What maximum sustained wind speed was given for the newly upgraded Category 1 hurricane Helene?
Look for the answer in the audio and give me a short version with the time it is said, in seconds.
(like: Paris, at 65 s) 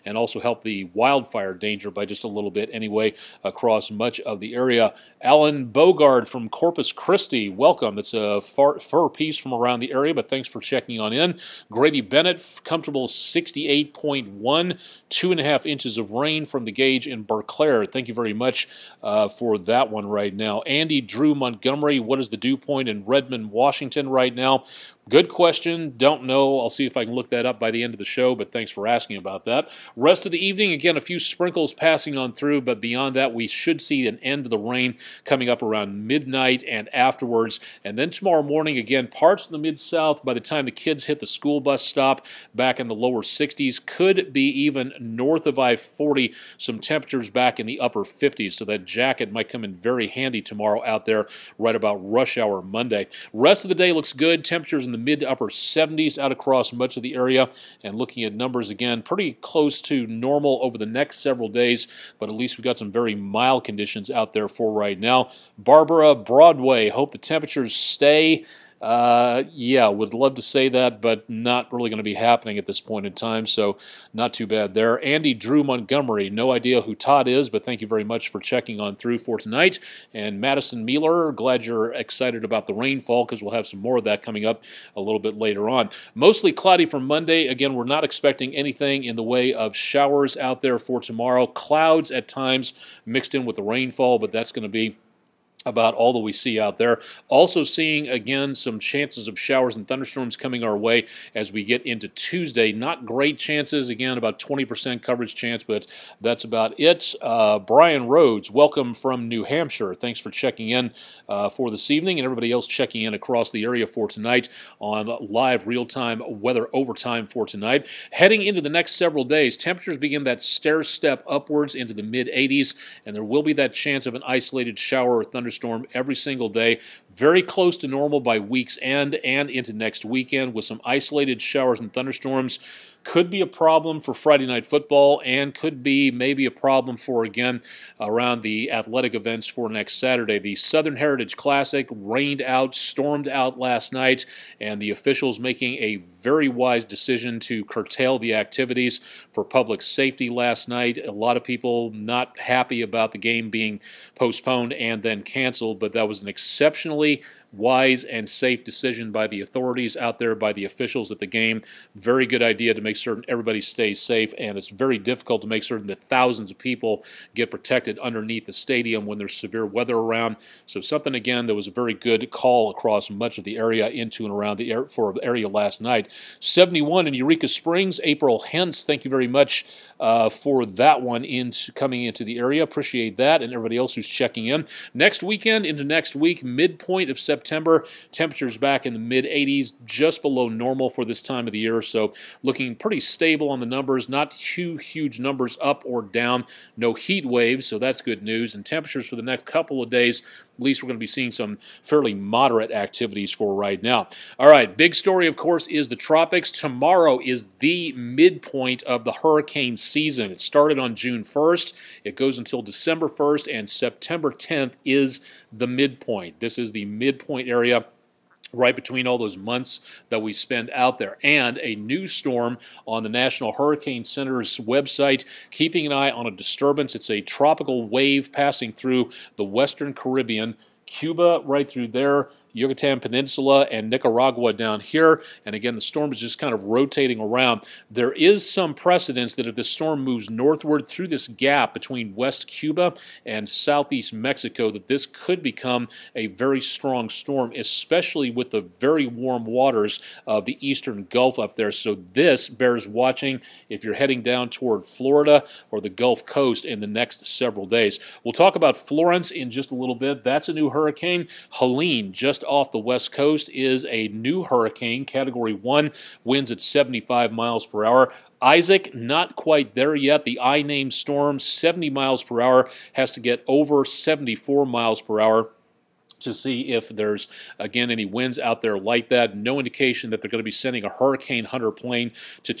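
75 mph, at 266 s.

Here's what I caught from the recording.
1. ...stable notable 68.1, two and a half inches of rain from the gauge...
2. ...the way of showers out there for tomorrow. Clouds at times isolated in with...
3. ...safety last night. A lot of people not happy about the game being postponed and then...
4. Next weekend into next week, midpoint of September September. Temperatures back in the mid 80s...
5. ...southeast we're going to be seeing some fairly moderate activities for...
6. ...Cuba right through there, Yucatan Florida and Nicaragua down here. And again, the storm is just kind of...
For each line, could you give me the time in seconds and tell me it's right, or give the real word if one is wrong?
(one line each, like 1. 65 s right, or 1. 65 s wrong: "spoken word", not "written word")
1. 12 s wrong: "comfortable", not "stable"
2. 89 s wrong: "mixed", not "isolated"
3. 149 s right
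4. 184 s right
5. 200 s wrong: "least", not "southeast"
6. 230 s wrong: "Peninsula", not "Florida".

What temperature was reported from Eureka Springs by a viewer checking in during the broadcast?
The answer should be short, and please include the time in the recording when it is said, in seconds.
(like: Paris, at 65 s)
71, at 176 s.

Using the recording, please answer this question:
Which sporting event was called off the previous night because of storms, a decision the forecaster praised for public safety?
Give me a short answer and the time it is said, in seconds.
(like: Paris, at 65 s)
The Southern Heritage Classic, at 140 s.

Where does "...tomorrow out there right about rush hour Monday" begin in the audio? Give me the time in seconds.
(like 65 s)
50 s.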